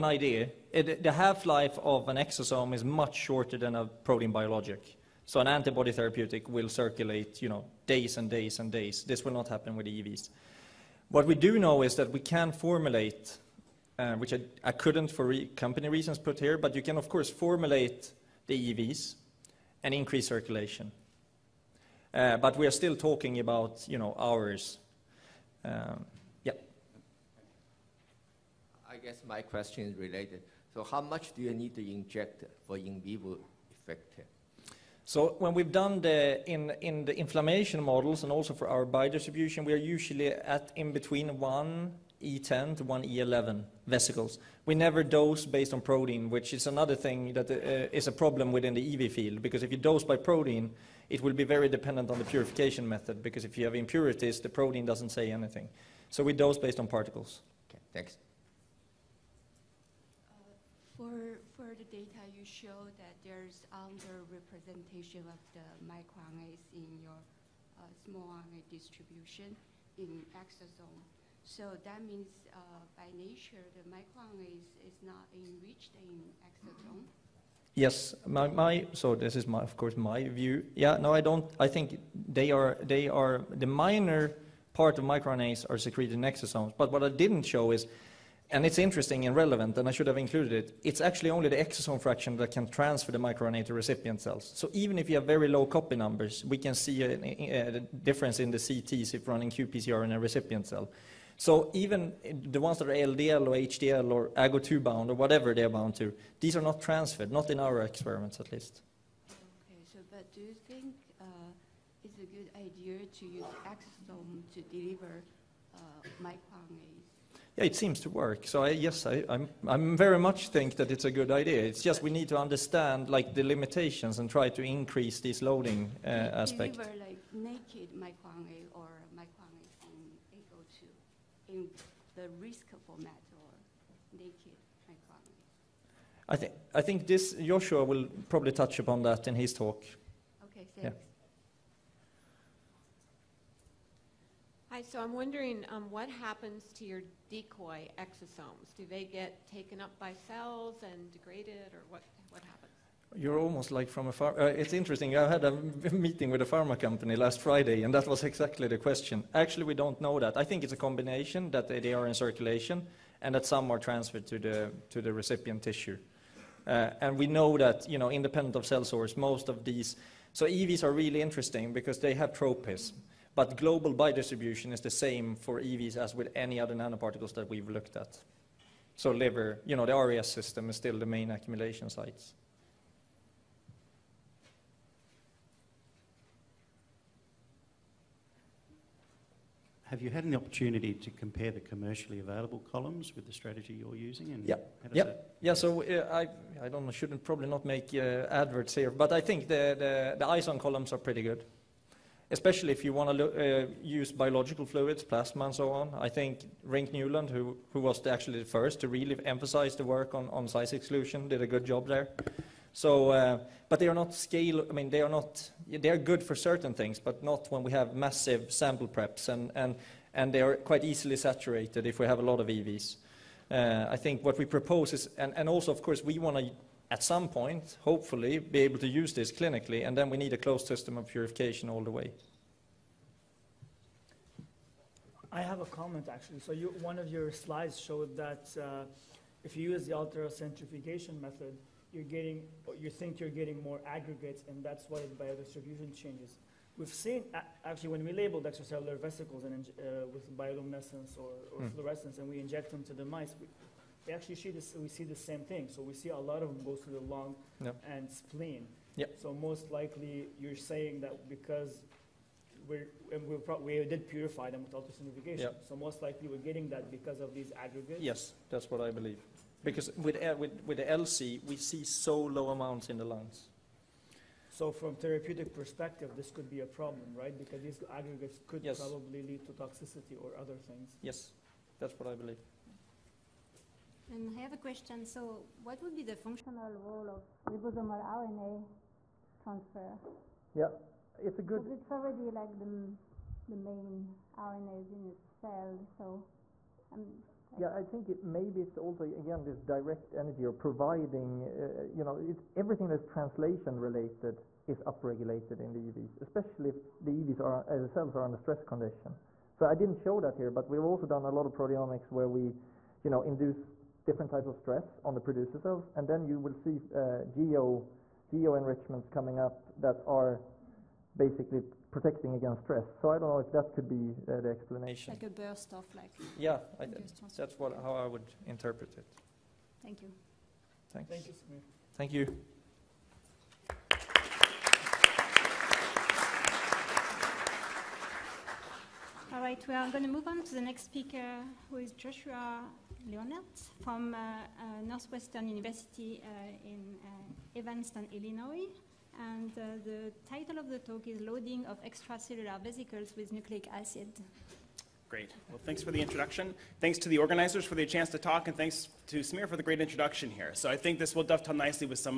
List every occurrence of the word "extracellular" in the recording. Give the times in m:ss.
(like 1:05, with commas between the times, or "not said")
4:08, 5:51.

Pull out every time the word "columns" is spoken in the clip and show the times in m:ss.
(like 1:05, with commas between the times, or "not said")
3:12, 3:20.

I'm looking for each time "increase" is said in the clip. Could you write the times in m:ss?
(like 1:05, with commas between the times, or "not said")
0:19, 2:04.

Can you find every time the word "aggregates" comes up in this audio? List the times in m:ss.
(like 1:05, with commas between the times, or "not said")
4:03, 4:27, 4:37.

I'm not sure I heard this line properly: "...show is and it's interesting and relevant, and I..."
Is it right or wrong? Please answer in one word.
right.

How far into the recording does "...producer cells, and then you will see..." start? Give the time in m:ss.
5:15.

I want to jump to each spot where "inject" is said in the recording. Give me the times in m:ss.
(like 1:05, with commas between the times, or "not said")
0:31, 4:12.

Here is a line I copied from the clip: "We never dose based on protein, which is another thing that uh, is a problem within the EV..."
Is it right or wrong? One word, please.
right.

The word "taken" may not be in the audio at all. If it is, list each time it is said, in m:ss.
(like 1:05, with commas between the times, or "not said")
2:29.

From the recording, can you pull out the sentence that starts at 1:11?
So that means uh, by nature, the microRNA is, is not enriched in exosome.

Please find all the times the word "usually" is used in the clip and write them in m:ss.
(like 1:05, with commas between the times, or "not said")
0:39.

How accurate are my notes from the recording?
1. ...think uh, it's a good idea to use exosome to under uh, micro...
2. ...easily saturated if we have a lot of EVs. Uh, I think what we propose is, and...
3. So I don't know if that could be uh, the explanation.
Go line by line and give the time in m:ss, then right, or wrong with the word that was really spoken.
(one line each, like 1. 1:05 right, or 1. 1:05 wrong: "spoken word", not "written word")
1. 1:50 wrong: "deliver", not "under"
2. 3:40 right
3. 5:22 right.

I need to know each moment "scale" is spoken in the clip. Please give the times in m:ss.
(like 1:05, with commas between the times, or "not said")
3:34.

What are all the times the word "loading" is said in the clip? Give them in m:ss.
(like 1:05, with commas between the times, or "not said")
2:05, 5:51.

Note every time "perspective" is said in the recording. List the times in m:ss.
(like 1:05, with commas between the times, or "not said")
4:35.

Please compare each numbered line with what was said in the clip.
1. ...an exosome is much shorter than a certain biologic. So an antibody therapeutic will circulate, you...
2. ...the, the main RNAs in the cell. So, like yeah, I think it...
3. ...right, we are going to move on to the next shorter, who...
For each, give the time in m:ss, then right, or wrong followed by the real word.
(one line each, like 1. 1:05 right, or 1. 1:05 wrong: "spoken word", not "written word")
1. 0:02 wrong: "protein", not "certain"
2. 4:52 right
3. 5:39 wrong: "speaker", not "shorter".